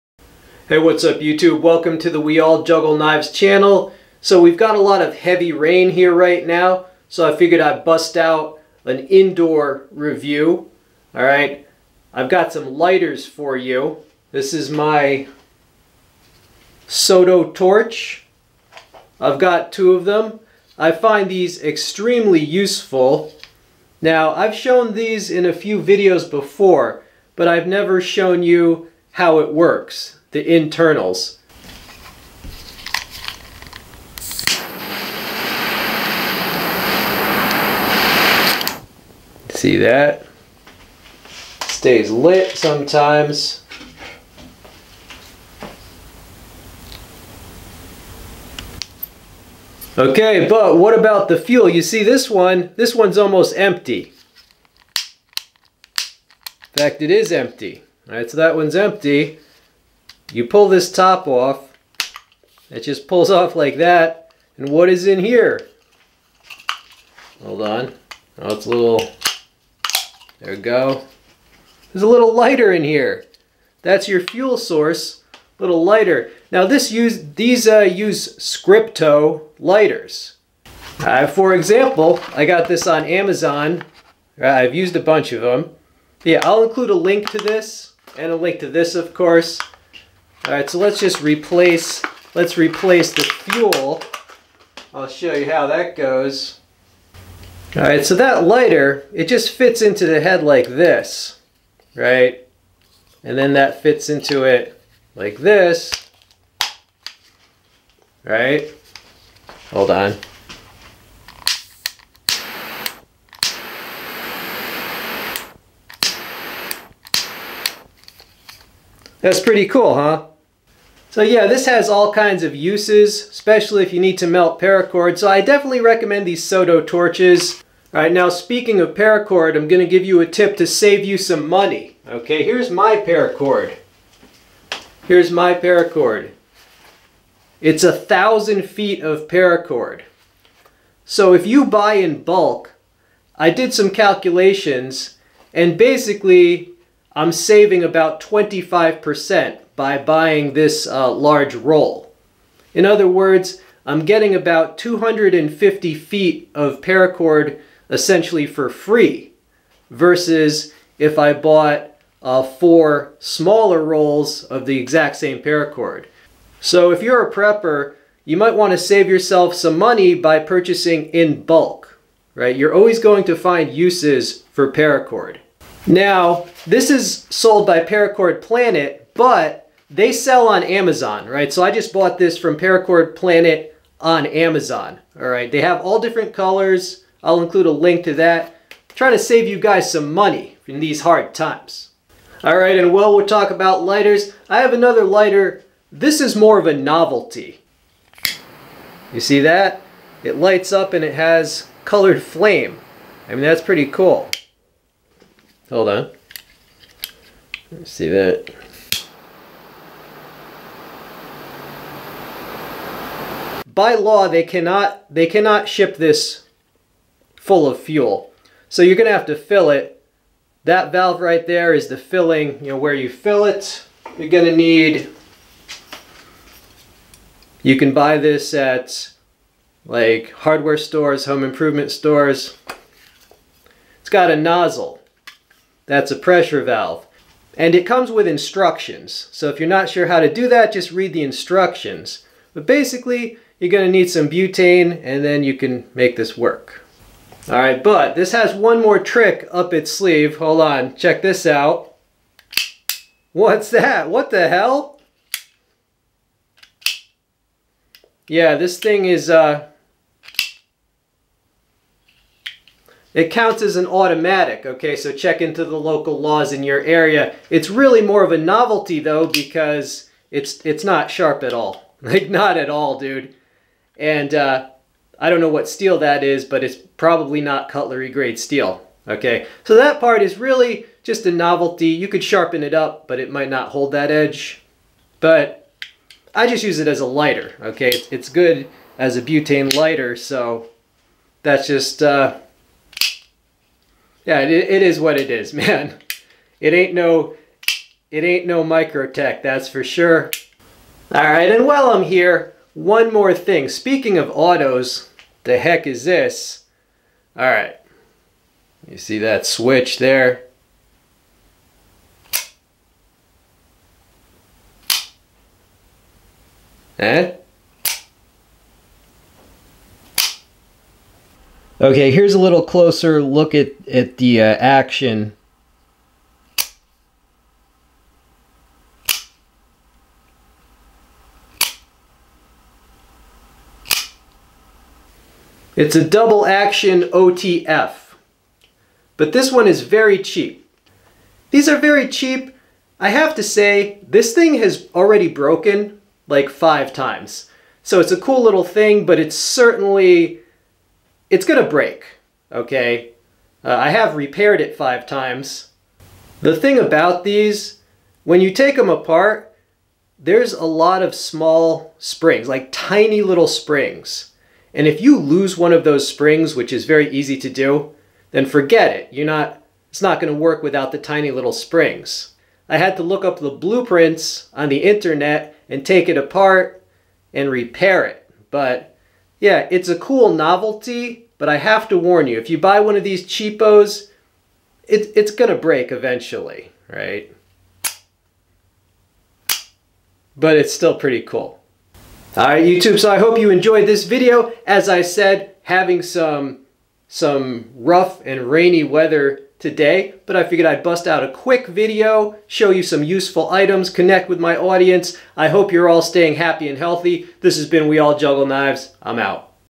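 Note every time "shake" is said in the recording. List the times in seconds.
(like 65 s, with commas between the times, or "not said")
not said.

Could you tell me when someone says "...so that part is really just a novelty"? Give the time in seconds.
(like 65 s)
279 s.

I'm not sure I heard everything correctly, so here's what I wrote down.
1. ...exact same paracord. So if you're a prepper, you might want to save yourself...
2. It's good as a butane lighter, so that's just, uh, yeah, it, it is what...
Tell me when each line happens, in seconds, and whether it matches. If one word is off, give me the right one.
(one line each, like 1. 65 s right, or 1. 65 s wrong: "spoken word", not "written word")
1. 164 s right
2. 288 s right.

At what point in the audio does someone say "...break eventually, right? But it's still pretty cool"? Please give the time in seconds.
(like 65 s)
385 s.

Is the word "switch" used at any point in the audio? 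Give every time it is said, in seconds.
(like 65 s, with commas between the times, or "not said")
309 s.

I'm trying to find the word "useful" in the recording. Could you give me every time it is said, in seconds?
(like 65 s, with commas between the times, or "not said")
22 s, 403 s.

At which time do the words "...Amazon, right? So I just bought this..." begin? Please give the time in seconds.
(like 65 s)
180 s.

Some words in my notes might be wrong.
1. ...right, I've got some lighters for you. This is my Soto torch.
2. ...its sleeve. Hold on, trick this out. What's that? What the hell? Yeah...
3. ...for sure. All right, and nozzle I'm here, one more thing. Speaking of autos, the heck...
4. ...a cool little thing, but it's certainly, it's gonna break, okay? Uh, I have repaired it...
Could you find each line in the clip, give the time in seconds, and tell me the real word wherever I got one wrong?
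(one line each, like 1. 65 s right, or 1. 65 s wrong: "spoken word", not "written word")
1. 11 s right
2. 249 s wrong: "check", not "trick"
3. 299 s wrong: "while", not "nozzle"
4. 348 s right.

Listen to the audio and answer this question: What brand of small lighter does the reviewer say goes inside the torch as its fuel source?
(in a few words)
Scripto.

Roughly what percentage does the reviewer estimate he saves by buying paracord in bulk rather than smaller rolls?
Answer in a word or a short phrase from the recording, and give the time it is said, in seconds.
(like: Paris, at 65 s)
25%, at 148 s.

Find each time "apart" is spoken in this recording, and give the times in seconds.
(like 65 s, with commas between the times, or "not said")
358 s, 376 s.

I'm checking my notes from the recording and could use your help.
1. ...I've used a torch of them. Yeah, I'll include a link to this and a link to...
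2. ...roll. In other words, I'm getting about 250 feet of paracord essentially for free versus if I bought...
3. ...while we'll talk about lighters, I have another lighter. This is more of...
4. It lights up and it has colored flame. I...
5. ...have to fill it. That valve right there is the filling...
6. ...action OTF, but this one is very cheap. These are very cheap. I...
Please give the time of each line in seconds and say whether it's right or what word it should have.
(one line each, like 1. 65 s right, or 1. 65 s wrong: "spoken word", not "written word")
1. 84 s wrong: "bunch", not "torch"
2. 151 s right
3. 192 s right
4. 200 s right
5. 219 s right
6. 336 s right.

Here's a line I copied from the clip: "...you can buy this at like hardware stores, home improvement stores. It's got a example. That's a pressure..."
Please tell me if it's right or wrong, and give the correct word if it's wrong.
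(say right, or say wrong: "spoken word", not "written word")
wrong: "nozzle", not "example".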